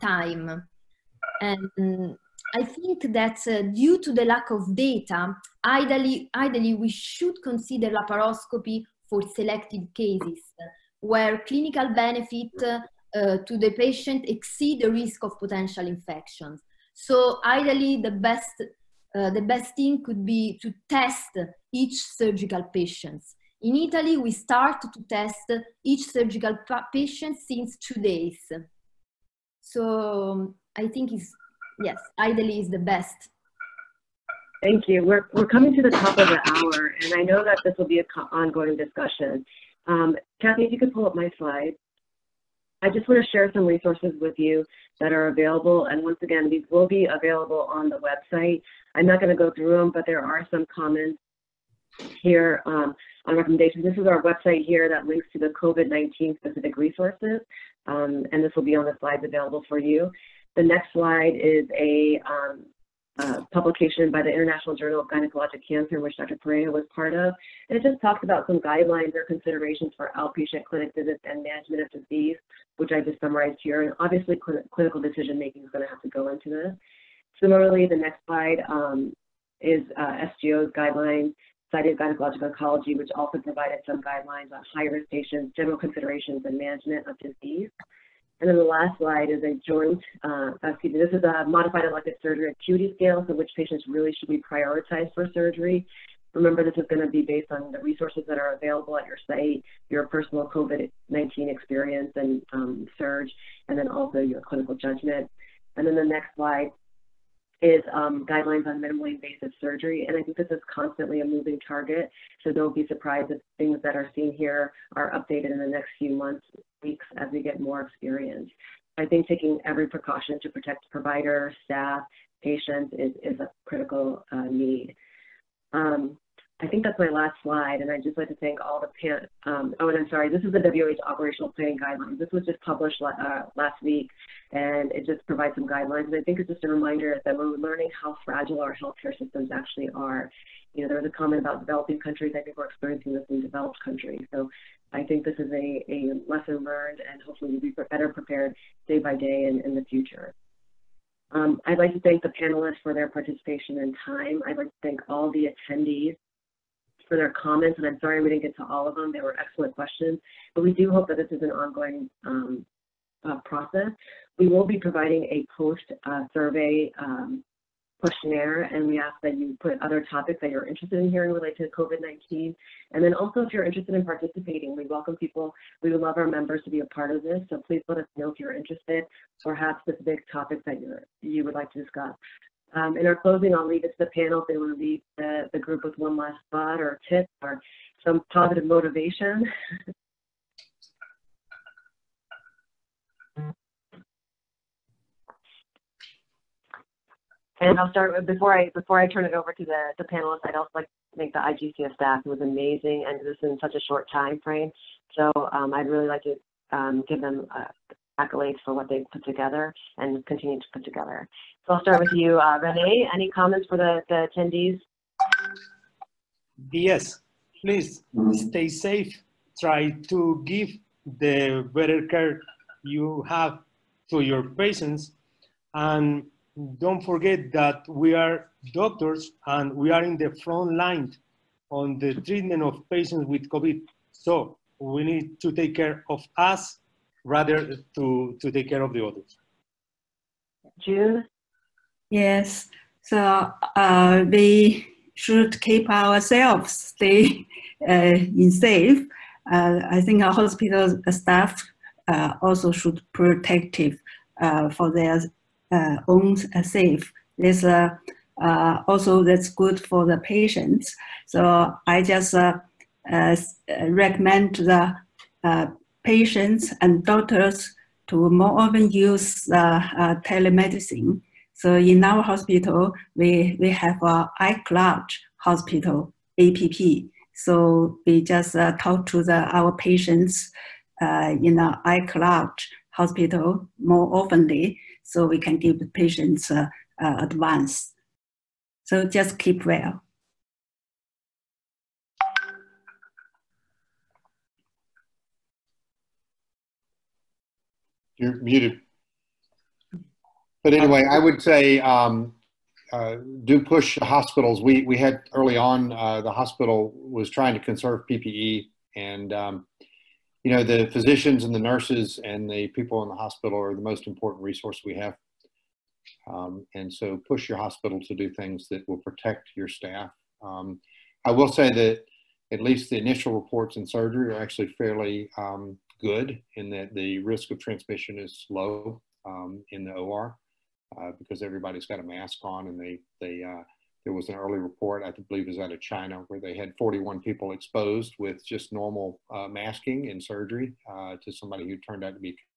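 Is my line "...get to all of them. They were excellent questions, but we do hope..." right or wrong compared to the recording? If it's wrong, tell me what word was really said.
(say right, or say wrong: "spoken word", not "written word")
right.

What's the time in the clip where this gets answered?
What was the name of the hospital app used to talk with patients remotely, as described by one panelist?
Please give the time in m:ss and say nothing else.
4:34.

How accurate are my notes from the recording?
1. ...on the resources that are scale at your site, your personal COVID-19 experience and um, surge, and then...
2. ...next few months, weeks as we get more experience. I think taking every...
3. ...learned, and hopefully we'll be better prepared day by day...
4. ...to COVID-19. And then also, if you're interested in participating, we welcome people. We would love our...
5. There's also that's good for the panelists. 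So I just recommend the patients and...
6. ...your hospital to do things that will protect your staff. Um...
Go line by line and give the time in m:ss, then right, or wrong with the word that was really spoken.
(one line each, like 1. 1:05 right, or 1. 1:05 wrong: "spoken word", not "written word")
1. 1:37 wrong: "available", not "scale"
2. 1:55 right
3. 2:26 right
4. 2:51 right
5. 4:17 wrong: "patients", not "panelists"
6. 5:17 right.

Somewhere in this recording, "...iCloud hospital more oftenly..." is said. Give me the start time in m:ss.
4:41.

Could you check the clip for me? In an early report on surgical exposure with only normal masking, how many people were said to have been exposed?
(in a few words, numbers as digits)
41.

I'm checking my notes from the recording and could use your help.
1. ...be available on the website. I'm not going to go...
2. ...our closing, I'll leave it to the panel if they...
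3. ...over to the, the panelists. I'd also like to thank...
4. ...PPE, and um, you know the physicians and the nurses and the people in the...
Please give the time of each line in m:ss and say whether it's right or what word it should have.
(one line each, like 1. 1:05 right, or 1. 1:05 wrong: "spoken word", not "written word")
1. 0:46 right
2. 3:03 right
3. 3:19 right
4. 5:08 right.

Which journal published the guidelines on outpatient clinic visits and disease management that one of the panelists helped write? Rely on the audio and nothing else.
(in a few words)
International Journal of Gynecologic Cancer.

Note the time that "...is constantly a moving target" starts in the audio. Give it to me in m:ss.
1:50.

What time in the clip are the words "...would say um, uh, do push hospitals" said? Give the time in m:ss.
5:01.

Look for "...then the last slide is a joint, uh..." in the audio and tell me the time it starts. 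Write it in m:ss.
1:28.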